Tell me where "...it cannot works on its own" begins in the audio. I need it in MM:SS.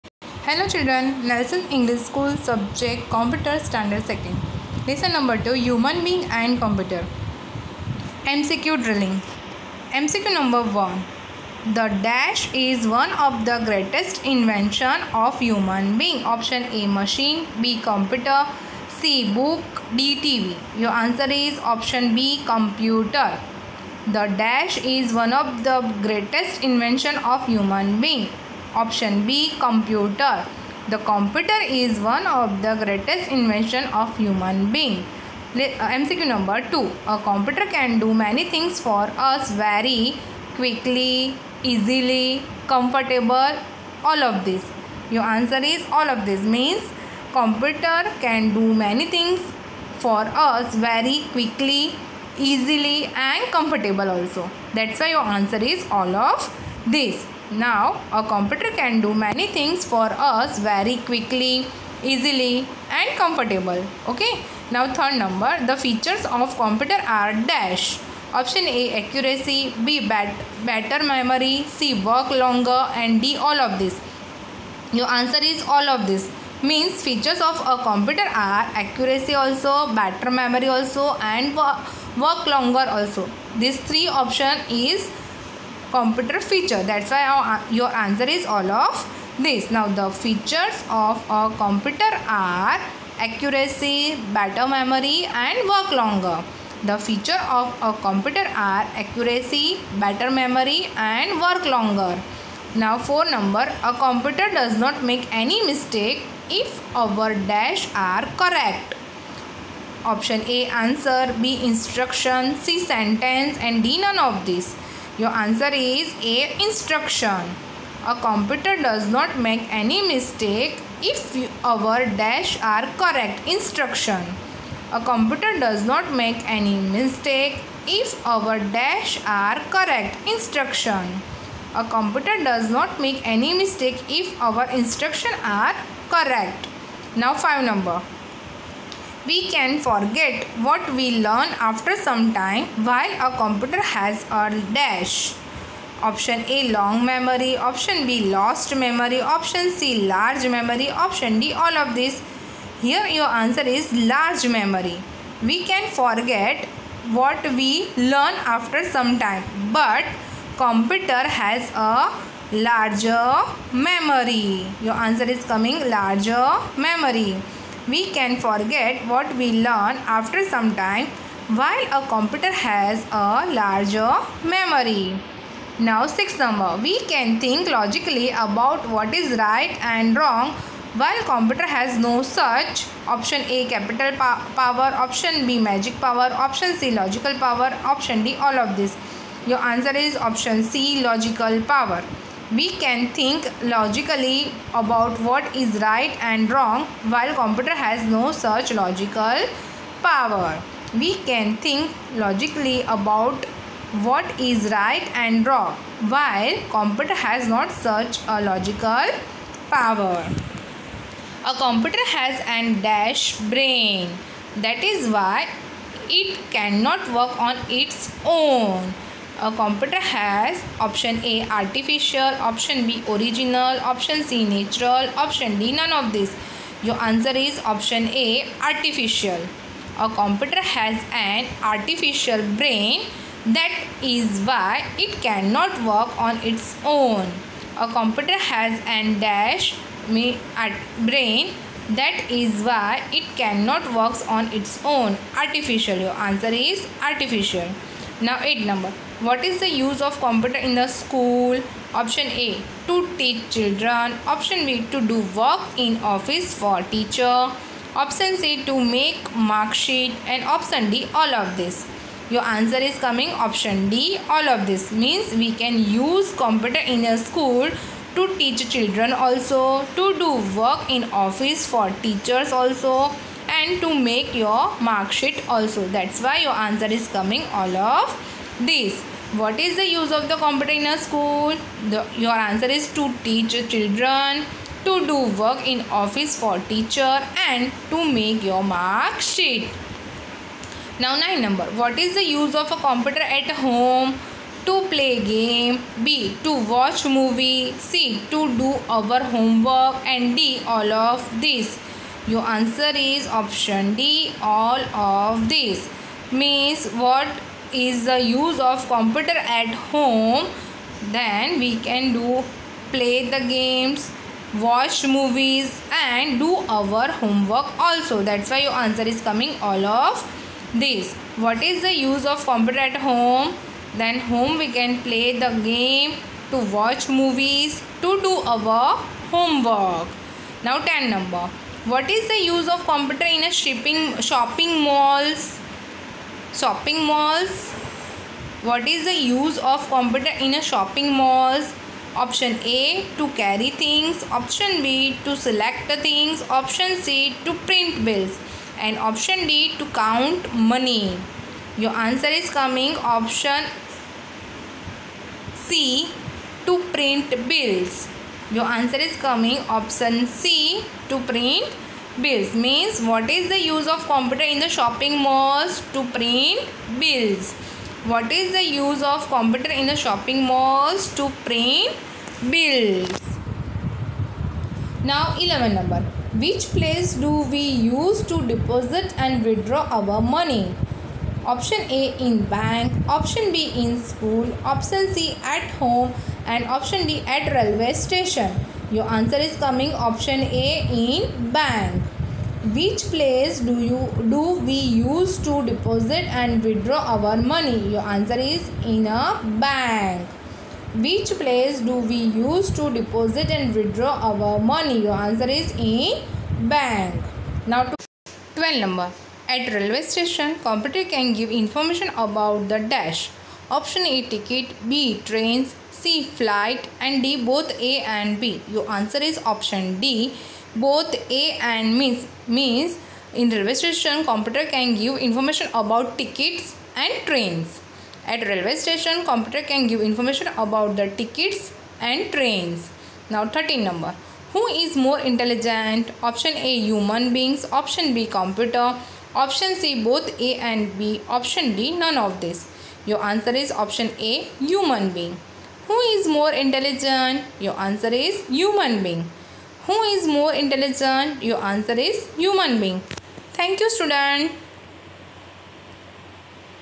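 04:03.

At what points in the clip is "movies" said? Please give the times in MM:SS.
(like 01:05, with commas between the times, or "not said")
04:57, 05:15, 05:27.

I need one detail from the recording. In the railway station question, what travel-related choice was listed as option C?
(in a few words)
Flight.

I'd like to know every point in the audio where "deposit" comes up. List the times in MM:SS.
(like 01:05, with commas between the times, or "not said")
06:18, 06:35, 06:42.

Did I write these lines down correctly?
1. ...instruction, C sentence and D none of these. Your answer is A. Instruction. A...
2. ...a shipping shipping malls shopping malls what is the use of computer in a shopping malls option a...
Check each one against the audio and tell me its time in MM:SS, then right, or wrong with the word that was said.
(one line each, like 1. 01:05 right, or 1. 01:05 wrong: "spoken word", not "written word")
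1. 01:51 right
2. 05:33 wrong: "shopping", not "shipping".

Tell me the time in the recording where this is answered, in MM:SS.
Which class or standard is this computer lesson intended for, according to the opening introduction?
00:03.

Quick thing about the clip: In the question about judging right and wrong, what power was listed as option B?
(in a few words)
Magic power.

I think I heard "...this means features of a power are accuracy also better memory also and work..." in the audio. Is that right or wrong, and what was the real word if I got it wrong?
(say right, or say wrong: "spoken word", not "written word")
wrong: "computer", not "power".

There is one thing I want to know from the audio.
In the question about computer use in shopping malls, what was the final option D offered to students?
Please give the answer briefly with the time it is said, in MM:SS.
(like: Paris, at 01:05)
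To count money, at 05:49.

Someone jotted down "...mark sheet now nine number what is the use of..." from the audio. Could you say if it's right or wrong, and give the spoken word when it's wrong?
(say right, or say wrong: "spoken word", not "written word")
right.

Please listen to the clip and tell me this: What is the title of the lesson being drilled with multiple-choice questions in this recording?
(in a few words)
Human Being and Computer.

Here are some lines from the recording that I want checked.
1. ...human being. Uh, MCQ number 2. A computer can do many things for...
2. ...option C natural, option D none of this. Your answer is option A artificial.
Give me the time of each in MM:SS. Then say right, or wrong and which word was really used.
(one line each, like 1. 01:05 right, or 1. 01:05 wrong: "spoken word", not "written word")
1. 00:34 right
2. 03:43 right.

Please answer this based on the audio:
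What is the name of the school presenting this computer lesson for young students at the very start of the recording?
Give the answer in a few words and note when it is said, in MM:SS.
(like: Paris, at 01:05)
Nelson English School, at 00:01.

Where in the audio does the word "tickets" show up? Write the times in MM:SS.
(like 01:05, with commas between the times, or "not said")
06:54, 07:06, 07:11.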